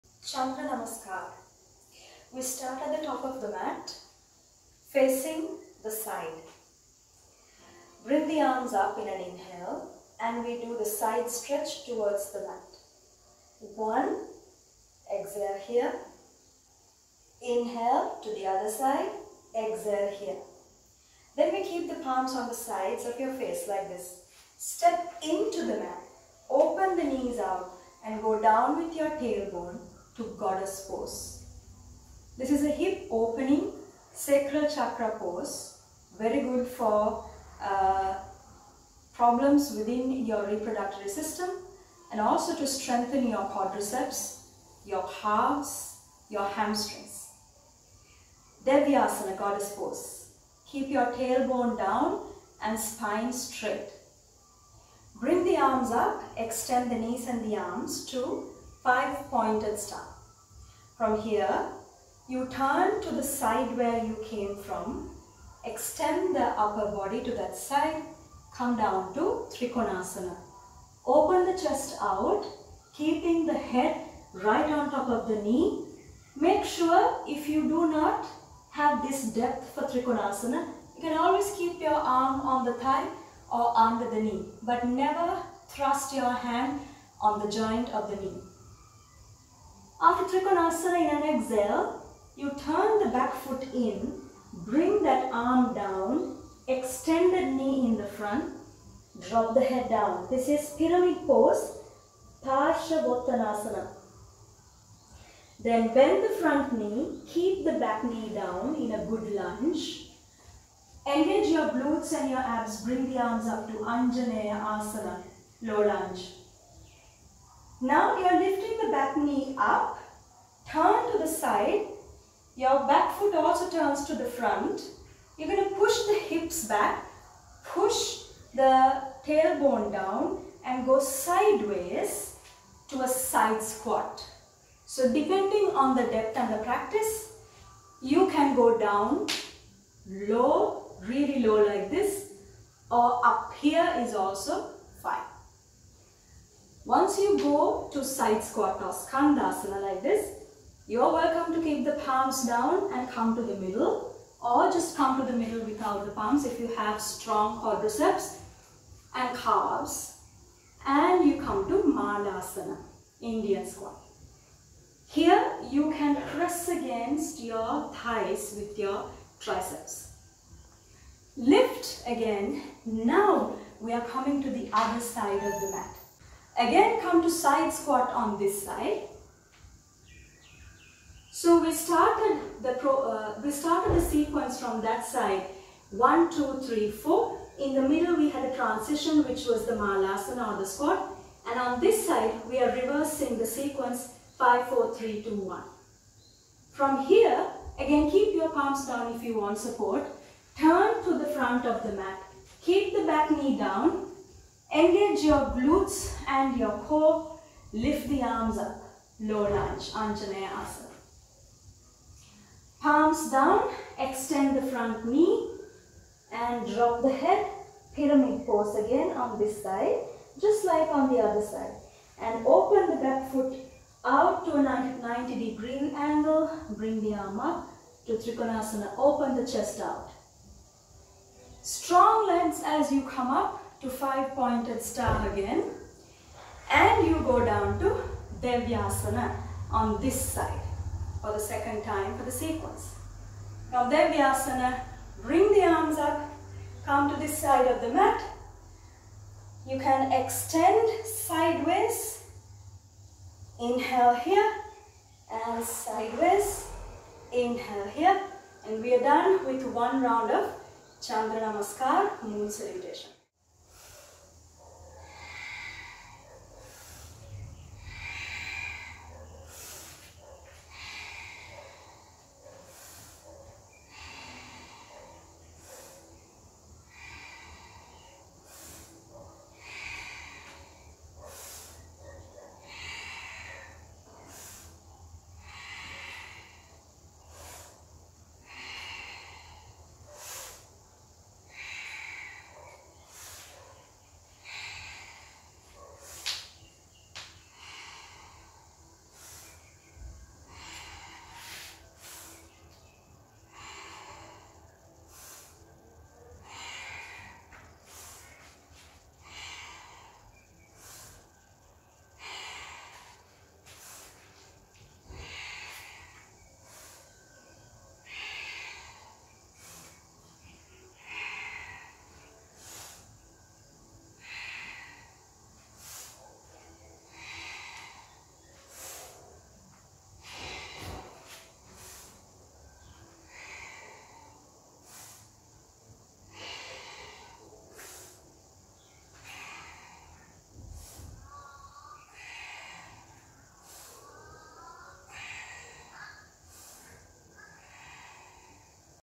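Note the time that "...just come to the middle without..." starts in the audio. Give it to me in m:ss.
2:34.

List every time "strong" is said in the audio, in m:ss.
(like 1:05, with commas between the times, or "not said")
2:36, 3:51.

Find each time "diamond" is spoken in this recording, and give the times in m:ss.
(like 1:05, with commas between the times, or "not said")
not said.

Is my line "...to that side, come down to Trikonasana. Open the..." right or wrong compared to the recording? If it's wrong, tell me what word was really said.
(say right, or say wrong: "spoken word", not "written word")
right.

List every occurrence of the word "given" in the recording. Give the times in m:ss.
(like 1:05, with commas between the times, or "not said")
not said.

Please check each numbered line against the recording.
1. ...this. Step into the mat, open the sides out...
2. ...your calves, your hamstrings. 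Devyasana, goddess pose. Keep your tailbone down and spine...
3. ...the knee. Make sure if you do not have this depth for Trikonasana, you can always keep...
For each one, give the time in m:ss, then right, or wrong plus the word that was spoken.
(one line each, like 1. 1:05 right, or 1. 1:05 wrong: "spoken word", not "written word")
1. 0:23 wrong: "knees", not "sides"
2. 0:44 right
3. 1:15 right.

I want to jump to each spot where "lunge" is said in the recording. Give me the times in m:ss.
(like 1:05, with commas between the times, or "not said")
1:49, 1:55, 3:29.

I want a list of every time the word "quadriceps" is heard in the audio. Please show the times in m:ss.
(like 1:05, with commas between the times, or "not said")
0:43, 2:37.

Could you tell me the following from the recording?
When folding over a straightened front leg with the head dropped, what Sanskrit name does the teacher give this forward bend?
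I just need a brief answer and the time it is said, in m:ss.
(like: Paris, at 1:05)
Parshavottanasana, at 1:42.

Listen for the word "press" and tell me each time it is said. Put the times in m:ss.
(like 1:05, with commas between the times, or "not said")
2:46.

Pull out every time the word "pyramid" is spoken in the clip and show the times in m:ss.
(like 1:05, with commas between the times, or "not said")
1:40, 3:37.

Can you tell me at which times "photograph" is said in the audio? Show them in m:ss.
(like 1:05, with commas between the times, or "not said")
not said.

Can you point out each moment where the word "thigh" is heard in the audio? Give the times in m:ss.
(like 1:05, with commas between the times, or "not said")
1:22, 2:47.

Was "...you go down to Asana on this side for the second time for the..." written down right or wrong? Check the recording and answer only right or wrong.
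wrong.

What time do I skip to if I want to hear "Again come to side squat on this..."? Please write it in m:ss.
2:56.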